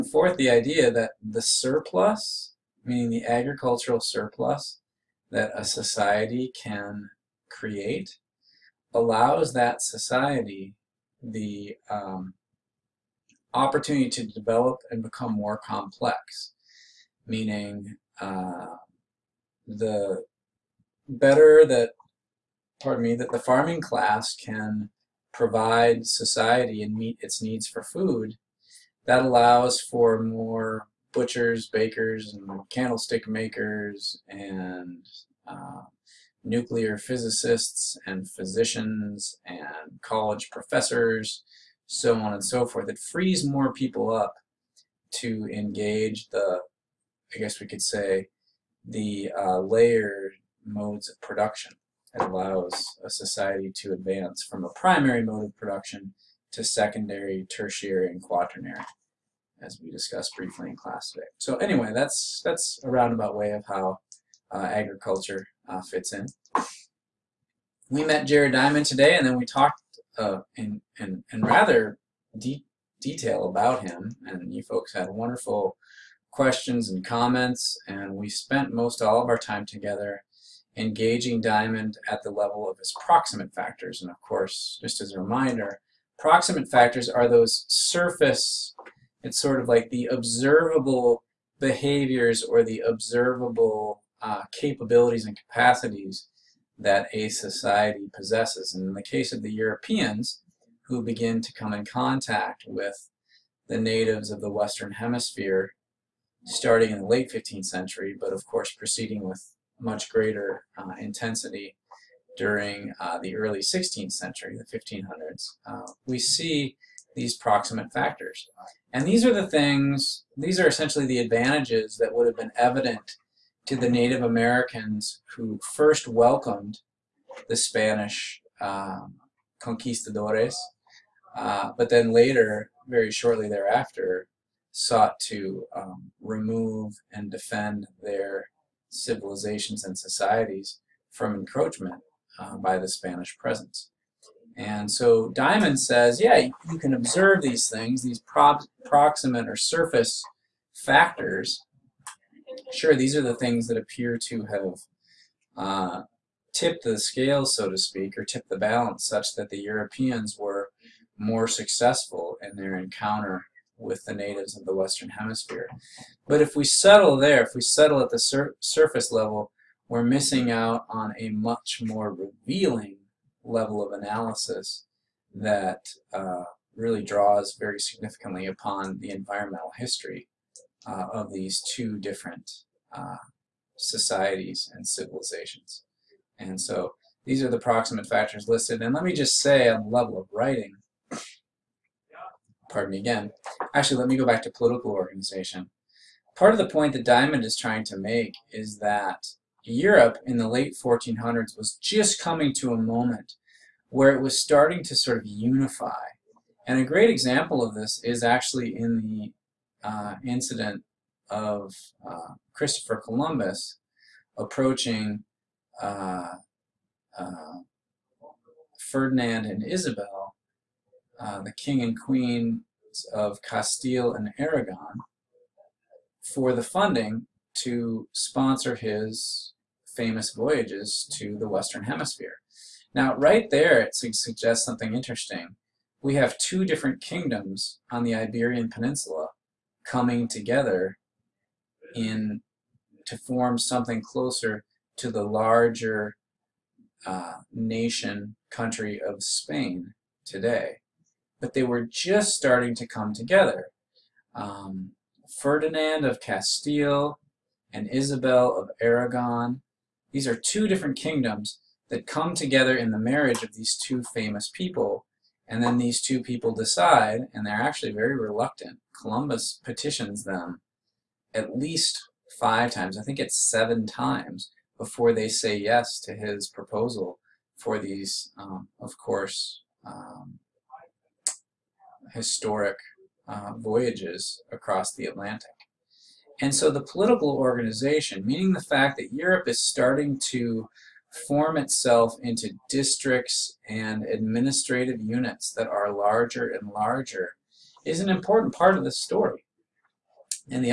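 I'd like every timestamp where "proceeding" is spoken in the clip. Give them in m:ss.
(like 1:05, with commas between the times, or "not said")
1:48.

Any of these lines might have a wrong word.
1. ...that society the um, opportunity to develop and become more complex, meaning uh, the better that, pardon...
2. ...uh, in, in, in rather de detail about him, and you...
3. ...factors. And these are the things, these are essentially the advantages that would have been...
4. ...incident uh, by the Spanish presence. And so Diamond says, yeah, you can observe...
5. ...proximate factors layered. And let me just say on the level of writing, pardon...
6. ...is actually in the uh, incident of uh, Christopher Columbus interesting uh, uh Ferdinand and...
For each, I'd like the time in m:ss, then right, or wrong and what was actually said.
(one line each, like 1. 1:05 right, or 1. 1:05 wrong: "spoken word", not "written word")
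1. 0:09 right
2. 1:10 right
3. 1:57 right
4. 2:21 wrong: "encroachment", not "incident"
5. 3:07 wrong: "listed", not "layered"
6. 3:28 wrong: "approaching", not "interesting".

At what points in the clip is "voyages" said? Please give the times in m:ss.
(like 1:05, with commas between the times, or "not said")
3:50, 4:43.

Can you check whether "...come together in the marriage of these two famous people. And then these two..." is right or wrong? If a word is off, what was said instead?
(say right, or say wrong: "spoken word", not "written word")
right.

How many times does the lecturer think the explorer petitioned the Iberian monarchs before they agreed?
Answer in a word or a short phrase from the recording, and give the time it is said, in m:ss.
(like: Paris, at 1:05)
7, at 4:33.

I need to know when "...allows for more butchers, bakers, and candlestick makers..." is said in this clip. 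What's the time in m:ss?
0:29.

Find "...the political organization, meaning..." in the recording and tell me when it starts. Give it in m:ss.
4:46.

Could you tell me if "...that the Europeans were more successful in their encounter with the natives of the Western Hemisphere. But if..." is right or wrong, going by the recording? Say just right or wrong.
right.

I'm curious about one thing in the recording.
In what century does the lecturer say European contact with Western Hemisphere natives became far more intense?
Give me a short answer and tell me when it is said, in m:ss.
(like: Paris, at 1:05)
16th century, at 1:53.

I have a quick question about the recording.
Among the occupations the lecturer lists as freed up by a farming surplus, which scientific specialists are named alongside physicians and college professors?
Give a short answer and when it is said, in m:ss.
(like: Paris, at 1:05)
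nuclear physicists, at 0:36.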